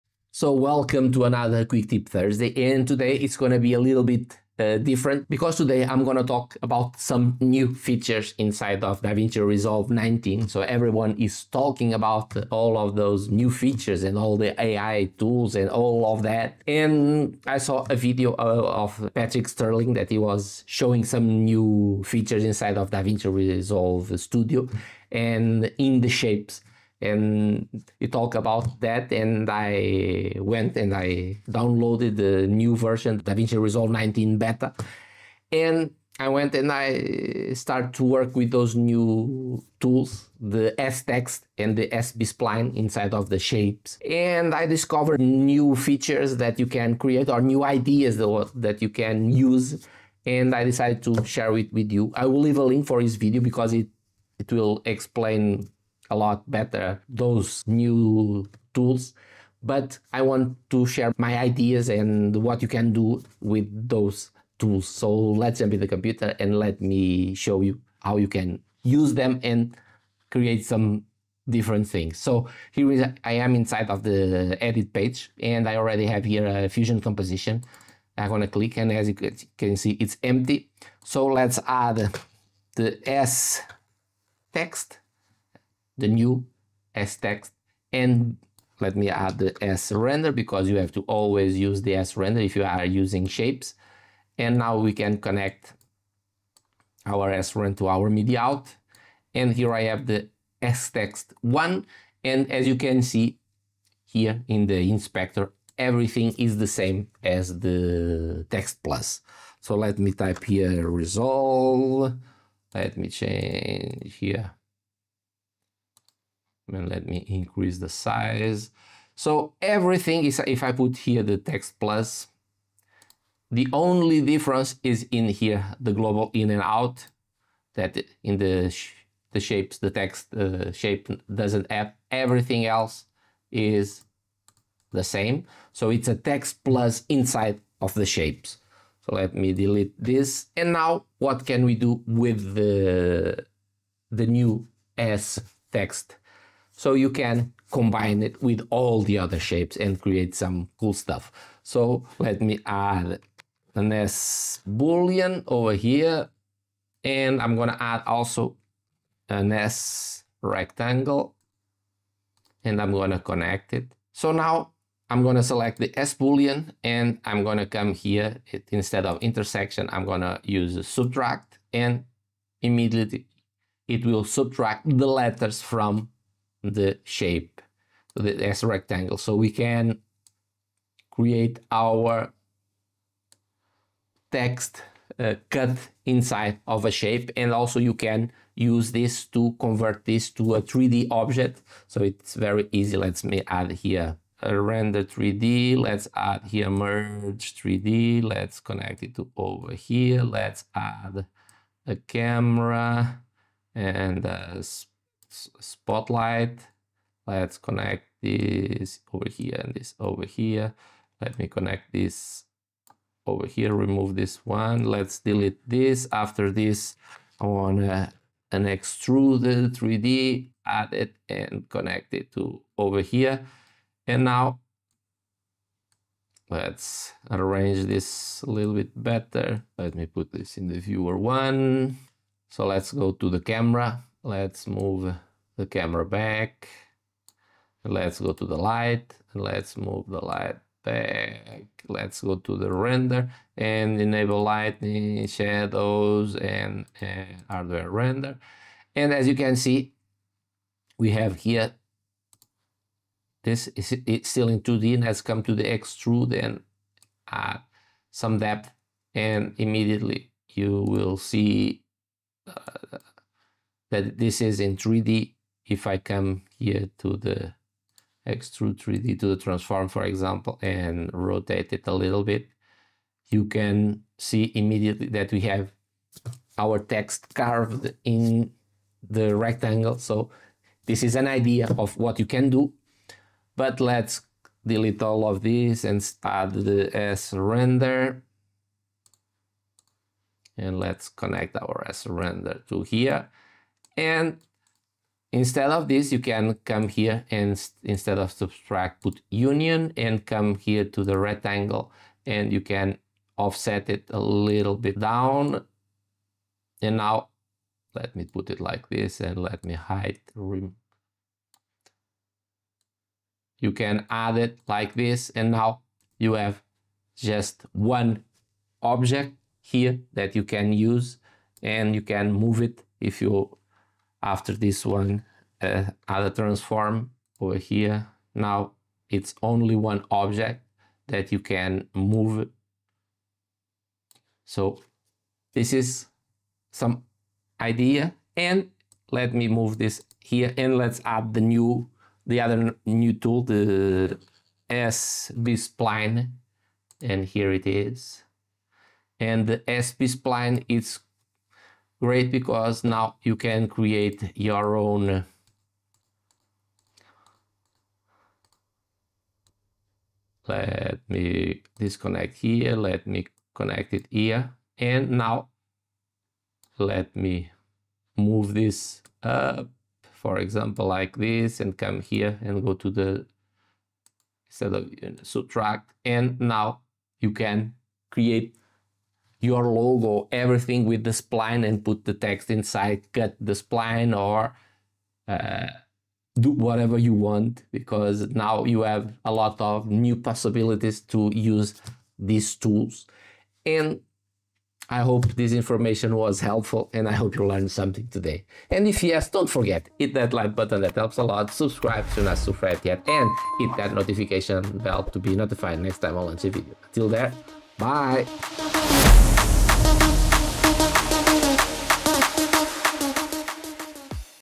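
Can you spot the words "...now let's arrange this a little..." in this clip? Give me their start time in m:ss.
3:44.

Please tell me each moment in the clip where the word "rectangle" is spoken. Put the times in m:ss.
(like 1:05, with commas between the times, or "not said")
2:40, 2:58, 4:39, 5:01.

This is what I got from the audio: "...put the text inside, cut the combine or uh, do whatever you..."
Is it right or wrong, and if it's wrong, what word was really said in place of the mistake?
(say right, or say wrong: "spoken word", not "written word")
wrong: "spline", not "combine".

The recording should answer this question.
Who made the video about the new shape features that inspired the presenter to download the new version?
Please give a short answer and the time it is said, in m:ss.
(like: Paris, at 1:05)
Patrick Sterling, at 0:19.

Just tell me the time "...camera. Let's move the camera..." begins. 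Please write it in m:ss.
3:53.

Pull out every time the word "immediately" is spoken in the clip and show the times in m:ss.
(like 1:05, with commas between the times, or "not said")
2:52, 4:19, 4:34.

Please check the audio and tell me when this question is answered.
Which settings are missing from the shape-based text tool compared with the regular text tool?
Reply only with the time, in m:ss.
2:05.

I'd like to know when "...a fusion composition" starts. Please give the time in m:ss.
1:16.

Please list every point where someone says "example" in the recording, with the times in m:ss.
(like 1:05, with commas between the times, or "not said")
4:30, 6:10.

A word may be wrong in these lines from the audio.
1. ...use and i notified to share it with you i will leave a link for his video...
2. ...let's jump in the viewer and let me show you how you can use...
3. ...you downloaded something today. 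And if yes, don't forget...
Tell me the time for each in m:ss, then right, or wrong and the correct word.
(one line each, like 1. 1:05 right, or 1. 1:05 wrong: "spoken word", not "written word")
1. 0:49 wrong: "decided", not "notified"
2. 1:05 wrong: "computer", not "viewer"
3. 6:37 wrong: "learned", not "downloaded".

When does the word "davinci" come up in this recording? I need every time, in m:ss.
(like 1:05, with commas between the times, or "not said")
0:09, 0:22, 0:33.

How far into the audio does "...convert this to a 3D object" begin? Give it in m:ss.
3:09.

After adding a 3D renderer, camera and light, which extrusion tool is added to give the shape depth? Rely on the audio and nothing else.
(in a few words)
extruded 3D.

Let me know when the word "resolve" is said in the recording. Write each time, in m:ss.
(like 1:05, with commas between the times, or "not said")
0:09, 0:23, 0:33, 1:50.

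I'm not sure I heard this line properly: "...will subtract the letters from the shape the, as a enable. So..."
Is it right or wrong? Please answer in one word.
wrong.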